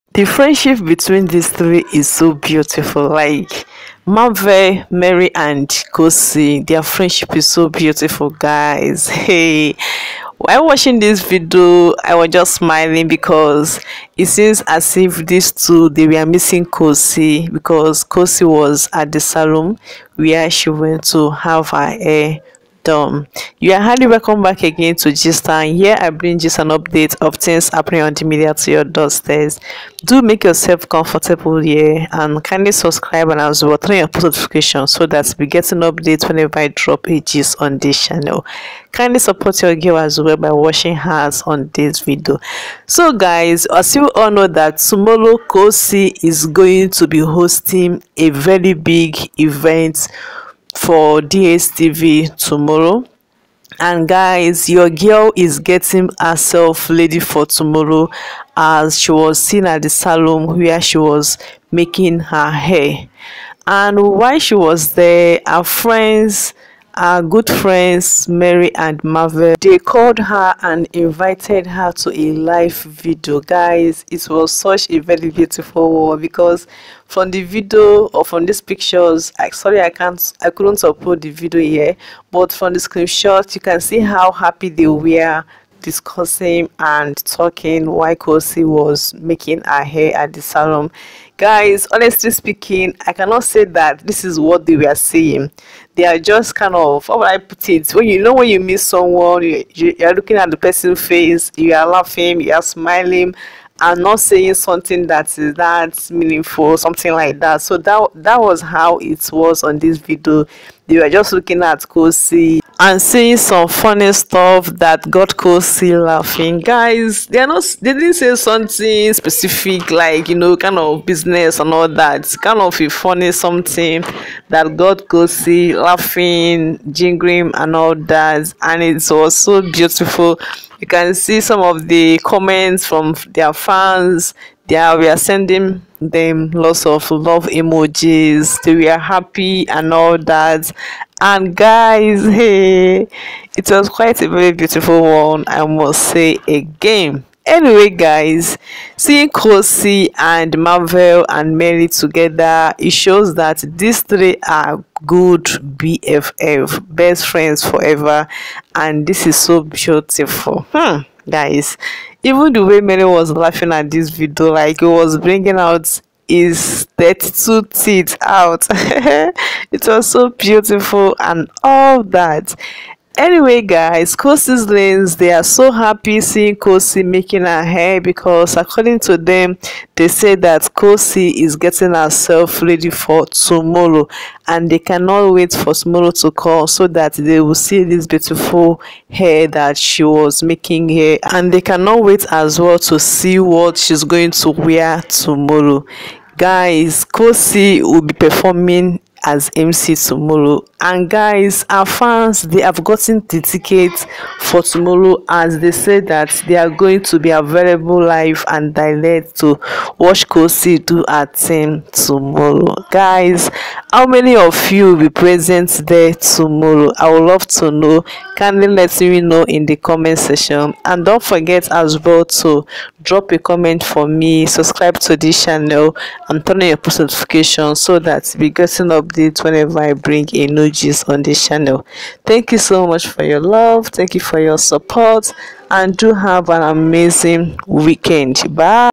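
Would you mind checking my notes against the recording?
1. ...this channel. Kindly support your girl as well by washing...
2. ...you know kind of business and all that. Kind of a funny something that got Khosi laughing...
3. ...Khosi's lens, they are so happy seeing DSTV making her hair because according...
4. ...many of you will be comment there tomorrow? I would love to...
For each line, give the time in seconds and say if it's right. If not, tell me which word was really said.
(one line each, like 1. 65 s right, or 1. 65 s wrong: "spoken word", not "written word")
1. 37 s right
2. 120 s right
3. 174 s wrong: "Khosi", not "DSTV"
4. 214 s wrong: "present", not "comment".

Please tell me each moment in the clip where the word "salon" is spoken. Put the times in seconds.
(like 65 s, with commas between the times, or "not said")
19 s, 59 s, 90 s.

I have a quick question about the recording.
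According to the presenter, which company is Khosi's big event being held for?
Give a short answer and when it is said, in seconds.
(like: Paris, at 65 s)
DSTV, at 51 s.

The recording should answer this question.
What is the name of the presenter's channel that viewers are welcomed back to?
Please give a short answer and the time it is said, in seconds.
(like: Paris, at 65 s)
Gist Town, at 25 s.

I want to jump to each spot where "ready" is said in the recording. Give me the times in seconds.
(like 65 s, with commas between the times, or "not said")
56 s, 182 s.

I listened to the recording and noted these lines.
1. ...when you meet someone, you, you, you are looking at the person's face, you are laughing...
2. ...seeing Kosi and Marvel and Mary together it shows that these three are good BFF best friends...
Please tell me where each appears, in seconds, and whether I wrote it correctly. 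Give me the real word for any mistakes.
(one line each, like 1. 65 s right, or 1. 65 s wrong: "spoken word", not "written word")
1. 98 s right
2. 148 s right.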